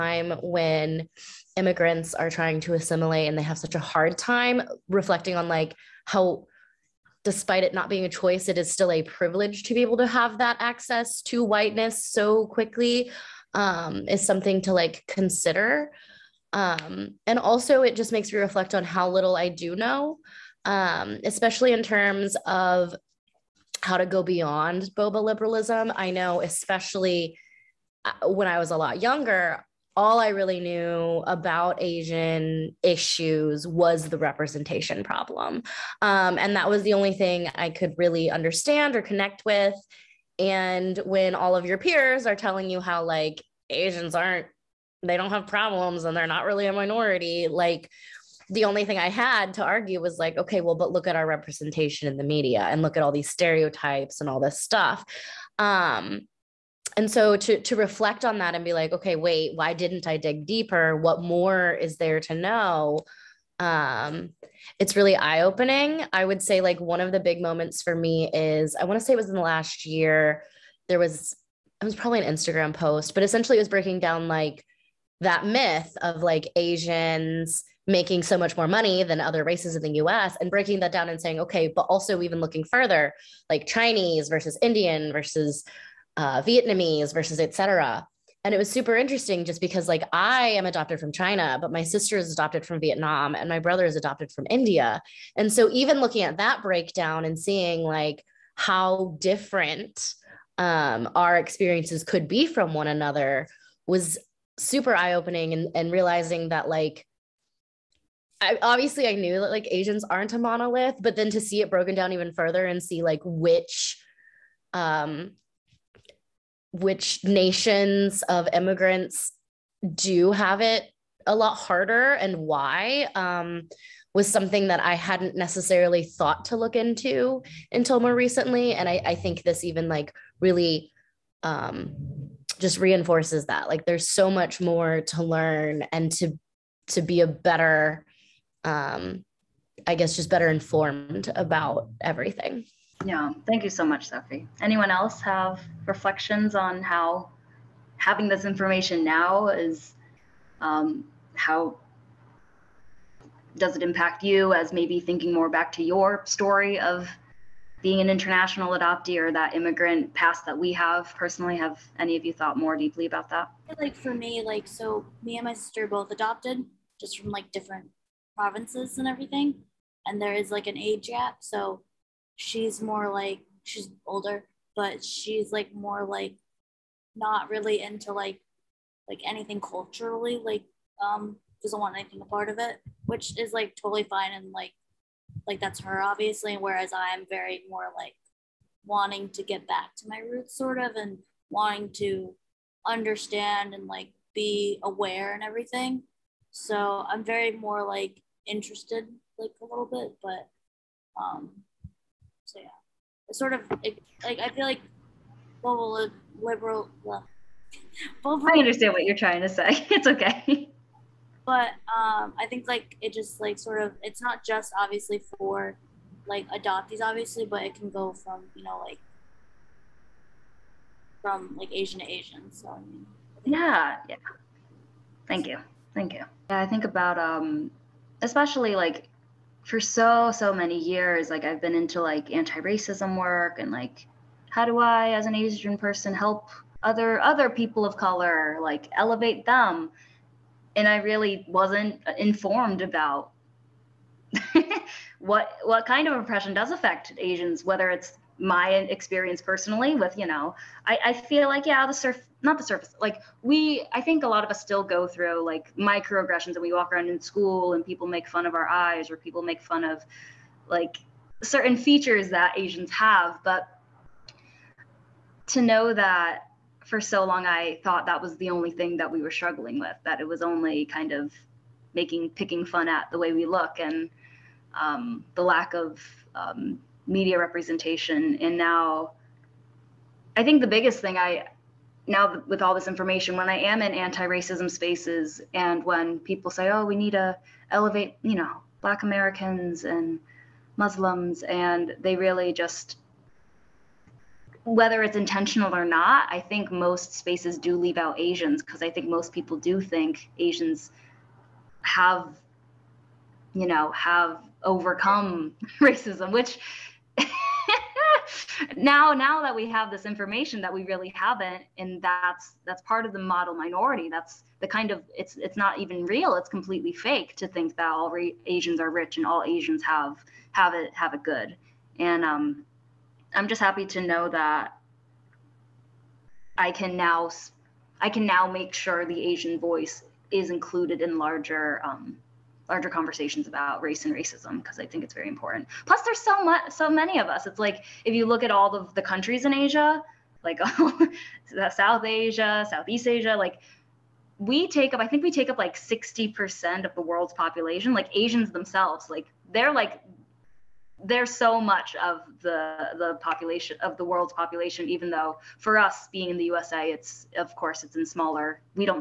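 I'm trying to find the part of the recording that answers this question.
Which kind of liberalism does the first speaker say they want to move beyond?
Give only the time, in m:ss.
0:24.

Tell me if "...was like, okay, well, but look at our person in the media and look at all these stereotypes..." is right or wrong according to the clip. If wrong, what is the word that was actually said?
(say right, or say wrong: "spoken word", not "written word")
wrong: "representation", not "person".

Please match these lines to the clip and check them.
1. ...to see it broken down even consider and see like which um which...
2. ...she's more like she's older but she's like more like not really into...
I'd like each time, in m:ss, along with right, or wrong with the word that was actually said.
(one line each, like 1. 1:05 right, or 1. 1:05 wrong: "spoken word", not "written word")
1. 1:51 wrong: "further", not "consider"
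2. 2:52 right.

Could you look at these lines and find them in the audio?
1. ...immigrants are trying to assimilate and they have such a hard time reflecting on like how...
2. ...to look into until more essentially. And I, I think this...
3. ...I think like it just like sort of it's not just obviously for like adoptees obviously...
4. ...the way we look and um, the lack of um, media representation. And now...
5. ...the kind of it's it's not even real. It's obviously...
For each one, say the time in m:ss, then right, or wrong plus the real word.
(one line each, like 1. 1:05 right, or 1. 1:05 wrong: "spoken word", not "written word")
1. 0:01 right
2. 2:06 wrong: "recently", not "essentially"
3. 3:32 right
4. 4:33 right
5. 5:14 wrong: "completely", not "obviously".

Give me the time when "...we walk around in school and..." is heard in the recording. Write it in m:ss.
4:16.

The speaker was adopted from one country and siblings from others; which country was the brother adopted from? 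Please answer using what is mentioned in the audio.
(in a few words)
India.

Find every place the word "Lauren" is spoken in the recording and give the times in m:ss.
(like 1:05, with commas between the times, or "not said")
not said.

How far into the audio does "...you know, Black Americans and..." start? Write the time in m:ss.
4:48.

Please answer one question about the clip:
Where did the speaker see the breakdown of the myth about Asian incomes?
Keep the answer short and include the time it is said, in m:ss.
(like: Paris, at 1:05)
Instagram post, at 1:11.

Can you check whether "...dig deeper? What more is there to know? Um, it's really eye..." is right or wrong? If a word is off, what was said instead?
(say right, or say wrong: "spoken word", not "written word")
right.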